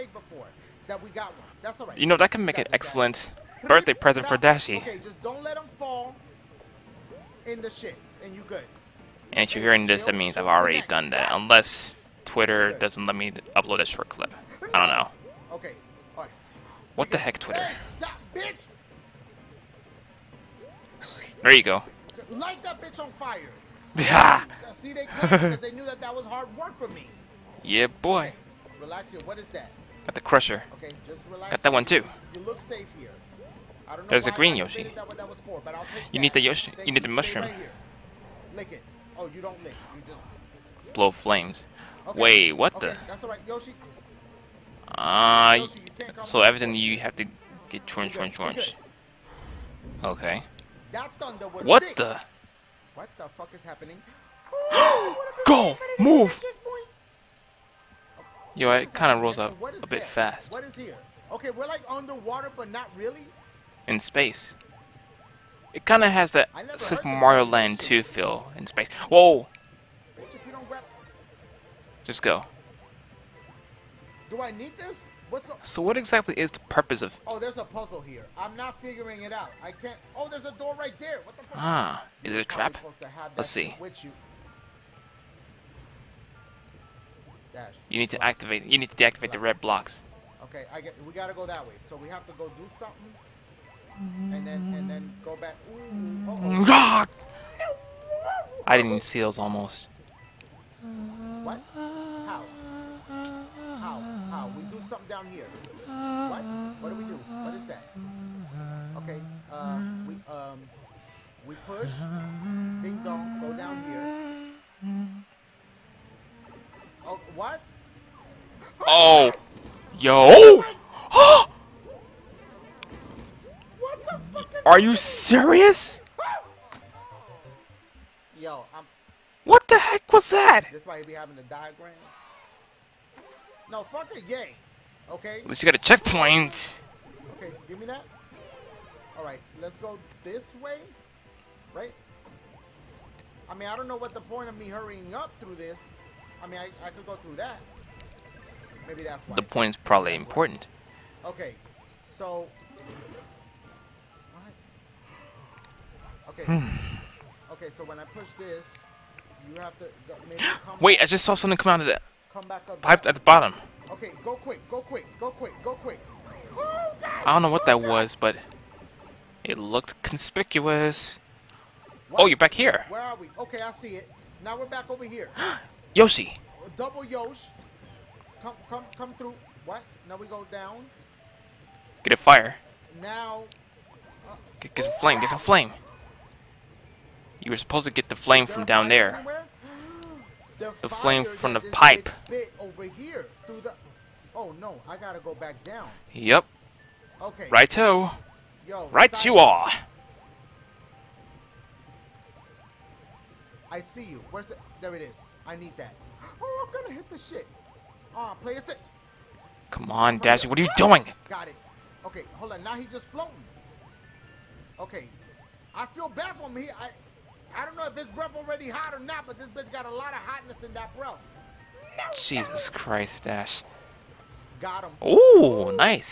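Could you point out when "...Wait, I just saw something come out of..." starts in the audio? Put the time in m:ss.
2:40.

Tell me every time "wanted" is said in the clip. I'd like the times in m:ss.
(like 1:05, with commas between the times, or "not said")
not said.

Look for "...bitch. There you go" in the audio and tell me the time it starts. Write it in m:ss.
0:18.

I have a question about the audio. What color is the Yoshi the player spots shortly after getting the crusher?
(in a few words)
Green.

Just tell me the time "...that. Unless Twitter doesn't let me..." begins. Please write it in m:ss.
0:11.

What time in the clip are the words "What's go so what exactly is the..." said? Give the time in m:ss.
1:15.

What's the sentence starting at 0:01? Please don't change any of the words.
You know that can make an excellent birthday present for Dashie.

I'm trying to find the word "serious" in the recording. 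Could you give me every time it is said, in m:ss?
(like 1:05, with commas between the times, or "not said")
2:04.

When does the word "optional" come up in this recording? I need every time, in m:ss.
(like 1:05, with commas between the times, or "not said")
not said.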